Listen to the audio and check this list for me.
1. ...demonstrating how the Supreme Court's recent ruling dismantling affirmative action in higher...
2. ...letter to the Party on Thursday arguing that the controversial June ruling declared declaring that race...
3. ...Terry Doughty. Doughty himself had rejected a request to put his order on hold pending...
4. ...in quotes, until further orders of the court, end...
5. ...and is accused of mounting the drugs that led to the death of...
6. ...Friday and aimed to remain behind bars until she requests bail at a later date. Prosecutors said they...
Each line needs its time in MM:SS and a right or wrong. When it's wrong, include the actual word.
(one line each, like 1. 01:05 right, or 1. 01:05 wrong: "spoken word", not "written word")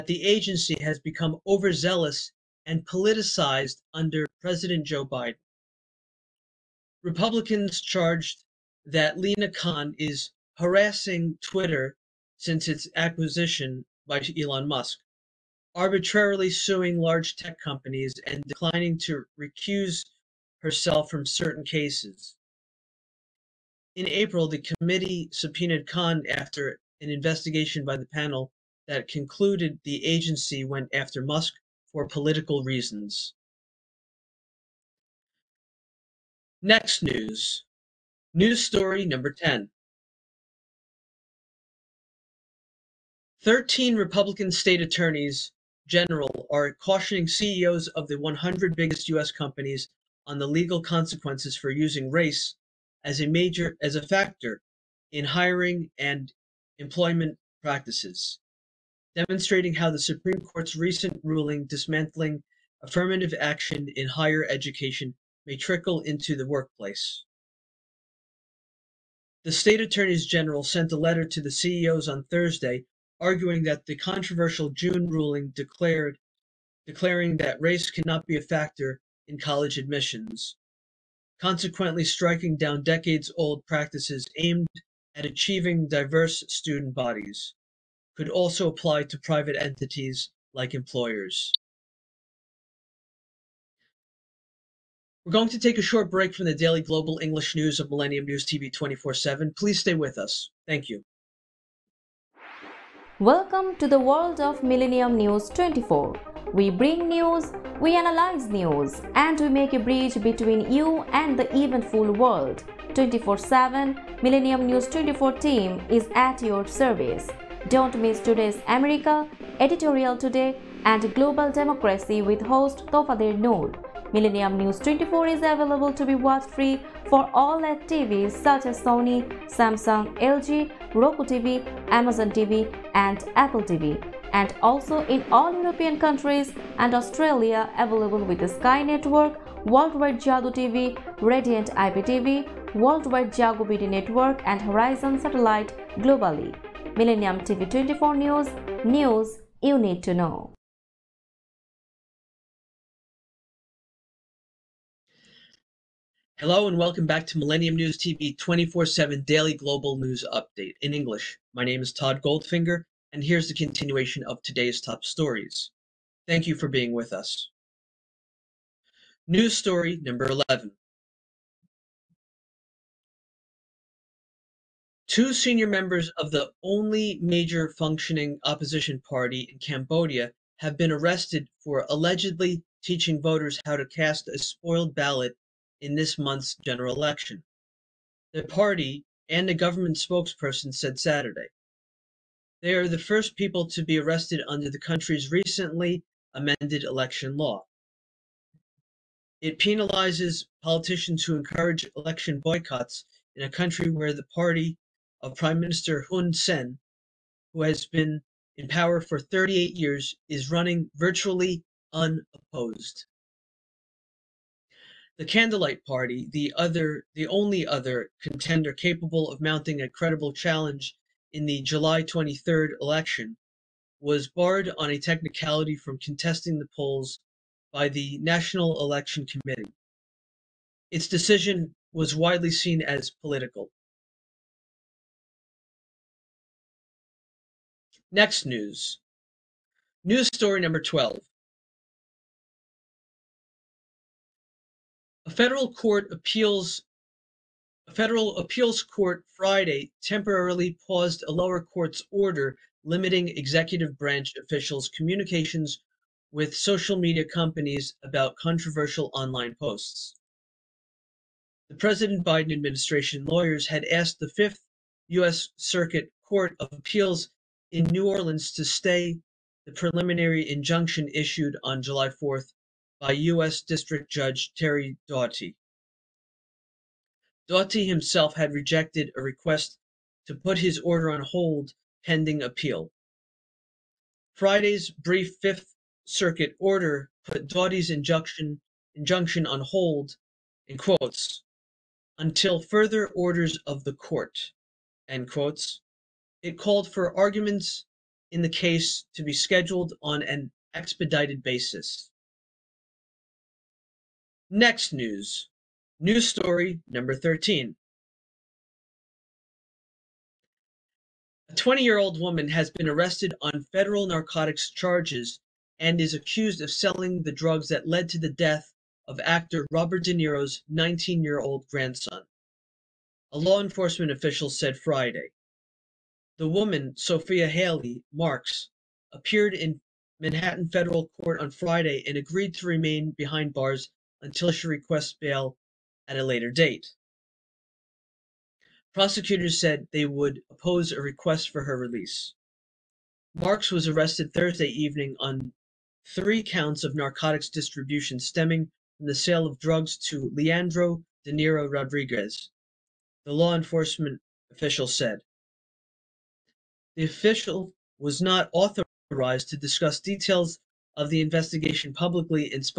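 1. 00:59 right
2. 01:10 wrong: "CEOs", not "Party"
3. 04:34 right
4. 04:50 right
5. 05:15 wrong: "selling", not "mounting"
6. 05:31 wrong: "agreed", not "aimed".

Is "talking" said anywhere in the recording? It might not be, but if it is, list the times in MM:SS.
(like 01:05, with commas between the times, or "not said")
not said.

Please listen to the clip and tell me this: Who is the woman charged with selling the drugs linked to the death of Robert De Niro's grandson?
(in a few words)
Sophia Haley Marks.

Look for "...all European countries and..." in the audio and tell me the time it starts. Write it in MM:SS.
02:15.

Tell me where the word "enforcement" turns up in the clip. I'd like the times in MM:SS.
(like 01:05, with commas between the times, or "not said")
05:23, 05:53.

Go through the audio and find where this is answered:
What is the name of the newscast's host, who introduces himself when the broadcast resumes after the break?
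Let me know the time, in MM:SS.
02:41.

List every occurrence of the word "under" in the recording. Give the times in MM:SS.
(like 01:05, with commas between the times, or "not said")
00:03, 03:14.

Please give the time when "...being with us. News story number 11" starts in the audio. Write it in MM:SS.
02:46.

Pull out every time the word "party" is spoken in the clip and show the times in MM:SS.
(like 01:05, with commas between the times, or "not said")
02:59, 03:08, 03:24, 03:35.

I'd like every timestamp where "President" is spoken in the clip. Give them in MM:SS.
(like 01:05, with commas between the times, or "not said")
00:04, 04:21.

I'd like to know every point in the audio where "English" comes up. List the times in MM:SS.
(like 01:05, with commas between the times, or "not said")
01:37, 02:40.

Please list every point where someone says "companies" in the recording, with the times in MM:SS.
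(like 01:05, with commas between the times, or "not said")
00:17, 00:49, 04:17.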